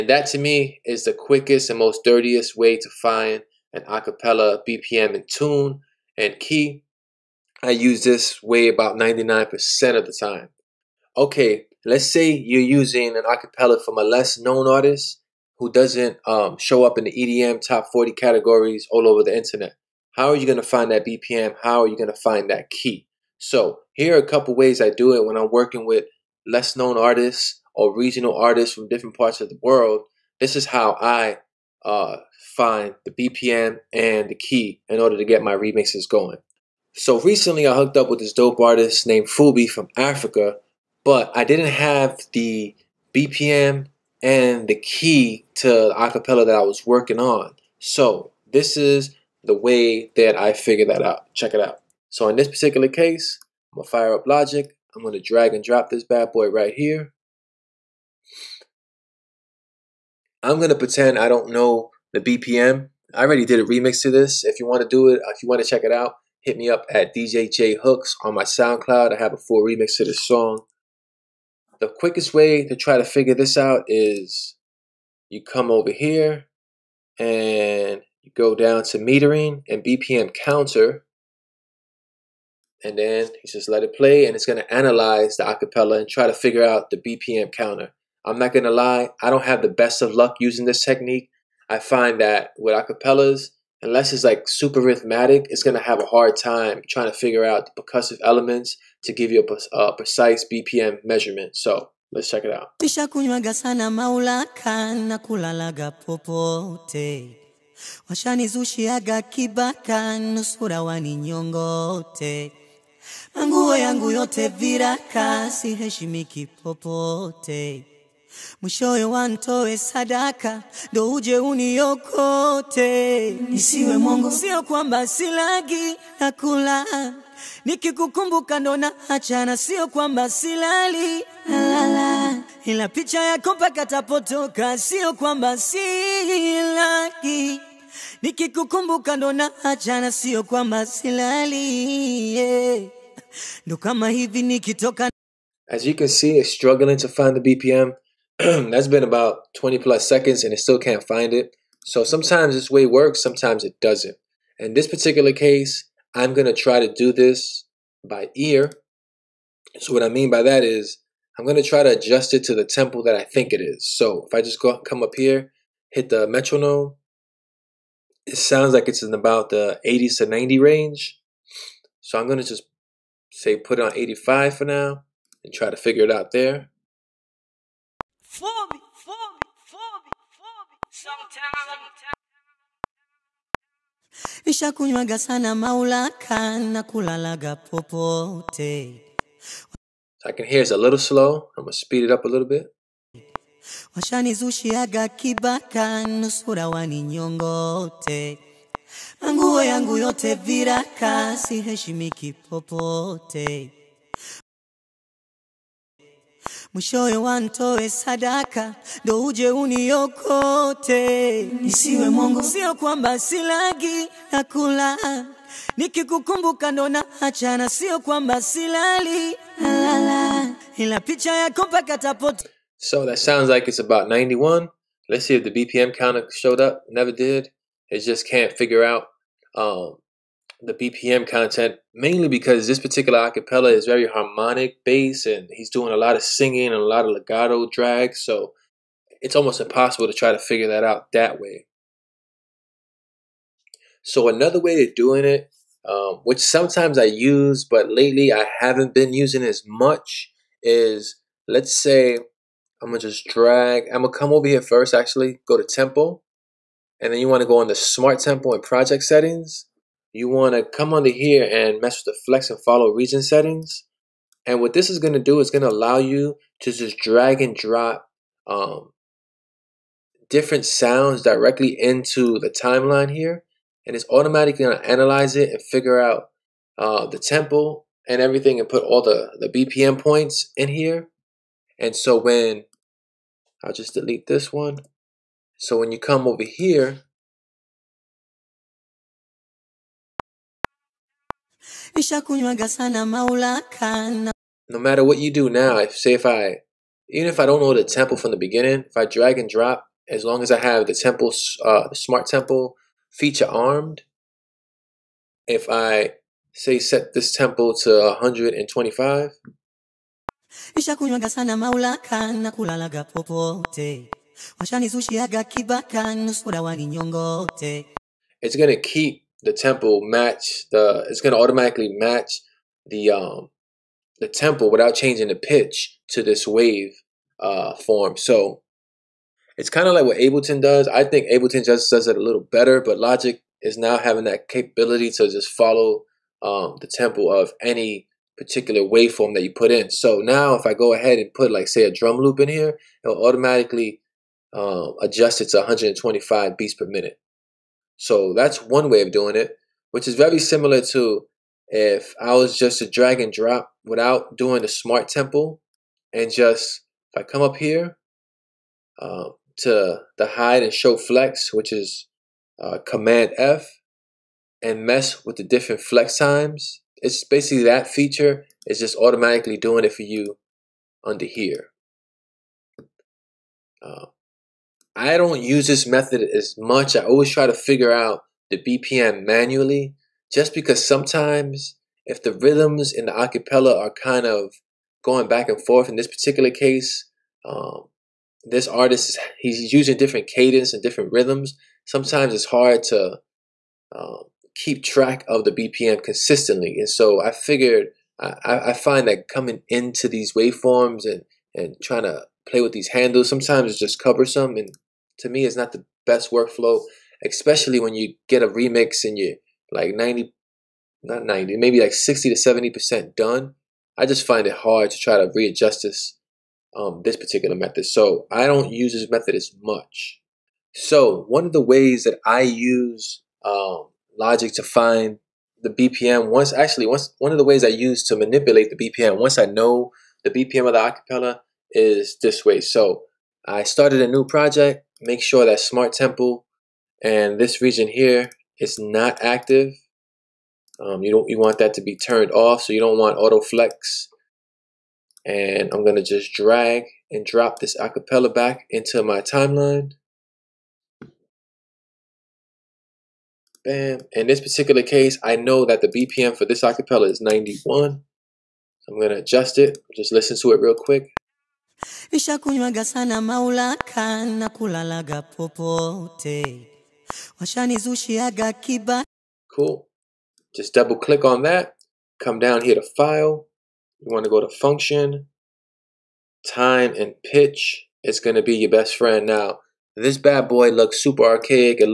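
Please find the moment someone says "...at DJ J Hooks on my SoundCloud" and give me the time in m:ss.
1:06.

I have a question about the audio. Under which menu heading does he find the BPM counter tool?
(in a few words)
Metering.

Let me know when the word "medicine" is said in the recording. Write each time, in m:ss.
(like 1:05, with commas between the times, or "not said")
not said.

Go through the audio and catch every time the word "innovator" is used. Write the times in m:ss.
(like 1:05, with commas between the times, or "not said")
not said.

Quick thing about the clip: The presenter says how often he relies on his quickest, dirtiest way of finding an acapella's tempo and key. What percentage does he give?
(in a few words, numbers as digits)
99%.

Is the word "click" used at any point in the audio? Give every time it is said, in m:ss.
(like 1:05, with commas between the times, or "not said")
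7:50.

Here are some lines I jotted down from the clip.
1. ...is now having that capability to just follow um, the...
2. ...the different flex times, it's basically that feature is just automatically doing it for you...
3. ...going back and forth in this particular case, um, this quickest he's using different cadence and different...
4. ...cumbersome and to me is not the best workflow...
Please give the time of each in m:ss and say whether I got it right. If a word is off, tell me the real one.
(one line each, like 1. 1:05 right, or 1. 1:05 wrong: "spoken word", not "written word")
1. 5:33 right
2. 6:05 right
3. 6:25 wrong: "artist", not "quickest"
4. 6:44 right.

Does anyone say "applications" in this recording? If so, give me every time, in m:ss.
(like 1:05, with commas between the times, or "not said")
not said.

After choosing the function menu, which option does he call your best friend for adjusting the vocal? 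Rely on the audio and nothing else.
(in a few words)
Time and pitch.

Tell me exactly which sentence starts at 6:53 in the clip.
I just find it hard to try to readjust this, um, this particular method.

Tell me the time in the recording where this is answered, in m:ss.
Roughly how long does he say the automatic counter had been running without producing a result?
2:29.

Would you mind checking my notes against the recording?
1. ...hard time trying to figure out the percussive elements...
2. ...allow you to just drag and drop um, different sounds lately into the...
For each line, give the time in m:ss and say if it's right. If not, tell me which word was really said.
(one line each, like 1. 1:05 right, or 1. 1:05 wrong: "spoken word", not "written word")
1. 1:36 right
2. 4:25 wrong: "directly", not "lately".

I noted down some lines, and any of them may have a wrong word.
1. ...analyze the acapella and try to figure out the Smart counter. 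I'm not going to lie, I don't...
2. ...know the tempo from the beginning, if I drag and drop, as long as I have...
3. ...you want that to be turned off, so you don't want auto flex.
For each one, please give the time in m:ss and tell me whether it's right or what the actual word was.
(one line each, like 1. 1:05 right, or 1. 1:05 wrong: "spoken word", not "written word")
1. 1:24 wrong: "BPM", not "Smart"
2. 4:57 right
3. 7:21 right.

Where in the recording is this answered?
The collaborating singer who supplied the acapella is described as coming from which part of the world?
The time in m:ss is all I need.
0:39.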